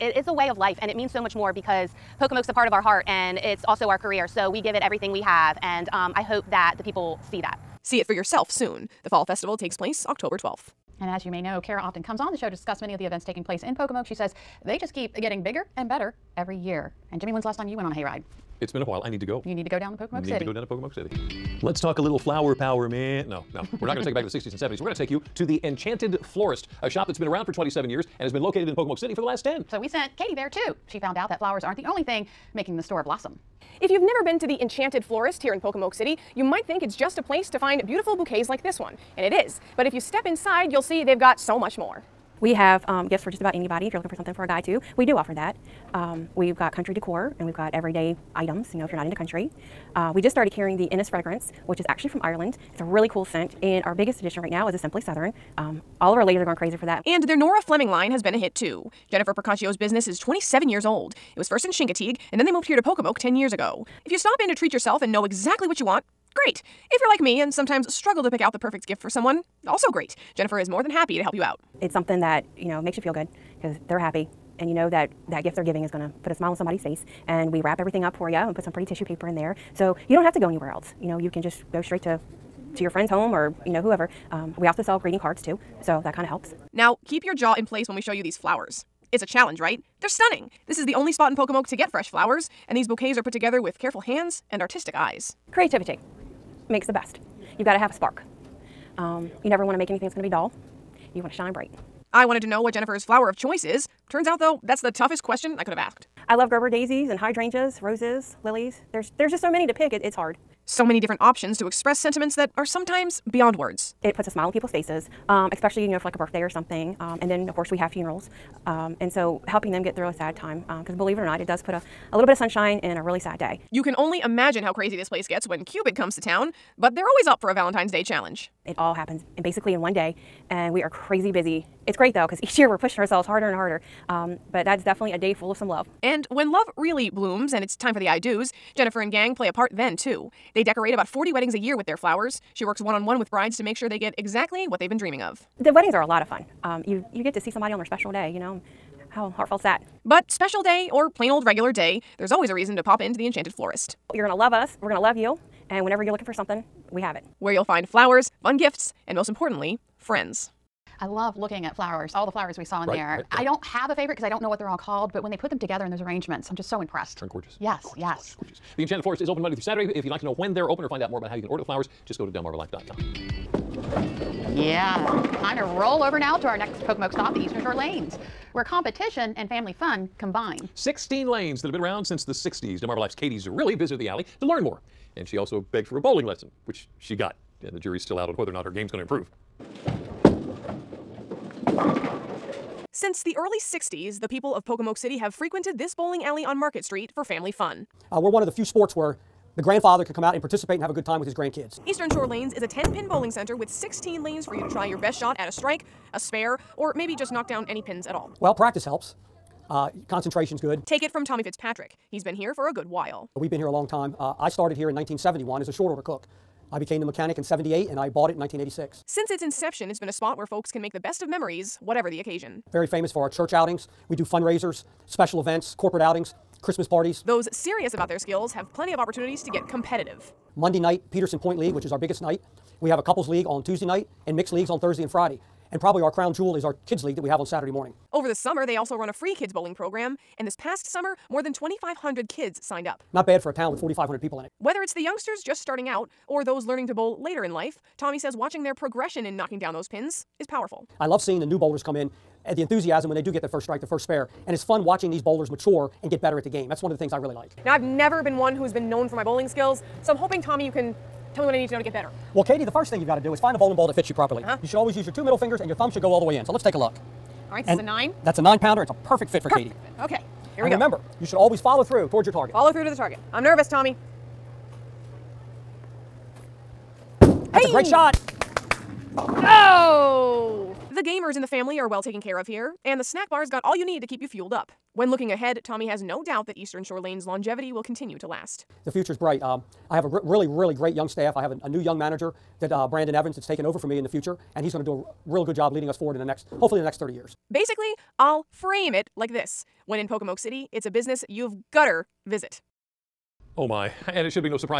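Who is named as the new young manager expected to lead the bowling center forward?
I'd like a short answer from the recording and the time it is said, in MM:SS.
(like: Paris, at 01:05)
Brandon Evans, at 04:52.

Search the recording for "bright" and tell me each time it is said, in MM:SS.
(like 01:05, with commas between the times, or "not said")
01:41, 04:49.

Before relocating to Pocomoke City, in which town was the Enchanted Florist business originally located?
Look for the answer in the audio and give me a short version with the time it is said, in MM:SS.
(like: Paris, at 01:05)
Chincoteague, at 01:01.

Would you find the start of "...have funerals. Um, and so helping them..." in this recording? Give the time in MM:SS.
01:57.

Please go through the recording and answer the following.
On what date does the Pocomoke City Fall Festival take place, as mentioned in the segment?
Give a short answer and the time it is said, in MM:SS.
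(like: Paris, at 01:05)
October 12, at 00:10.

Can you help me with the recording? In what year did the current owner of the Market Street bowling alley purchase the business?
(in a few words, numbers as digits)
1986.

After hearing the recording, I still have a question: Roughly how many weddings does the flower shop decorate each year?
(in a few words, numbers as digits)
40.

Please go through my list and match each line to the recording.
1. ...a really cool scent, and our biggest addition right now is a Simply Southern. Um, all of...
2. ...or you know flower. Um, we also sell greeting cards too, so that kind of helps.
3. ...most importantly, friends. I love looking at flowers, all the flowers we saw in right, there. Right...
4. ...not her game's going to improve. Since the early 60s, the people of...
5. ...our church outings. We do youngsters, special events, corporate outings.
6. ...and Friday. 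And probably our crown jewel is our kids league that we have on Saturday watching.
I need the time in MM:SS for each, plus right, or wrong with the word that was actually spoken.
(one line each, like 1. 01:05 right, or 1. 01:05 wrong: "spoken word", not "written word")
1. 00:52 right
2. 01:23 wrong: "whoever", not "flower"
3. 02:39 right
4. 03:08 right
5. 03:43 wrong: "fundraisers", not "youngsters"
6. 03:55 wrong: "morning", not "watching".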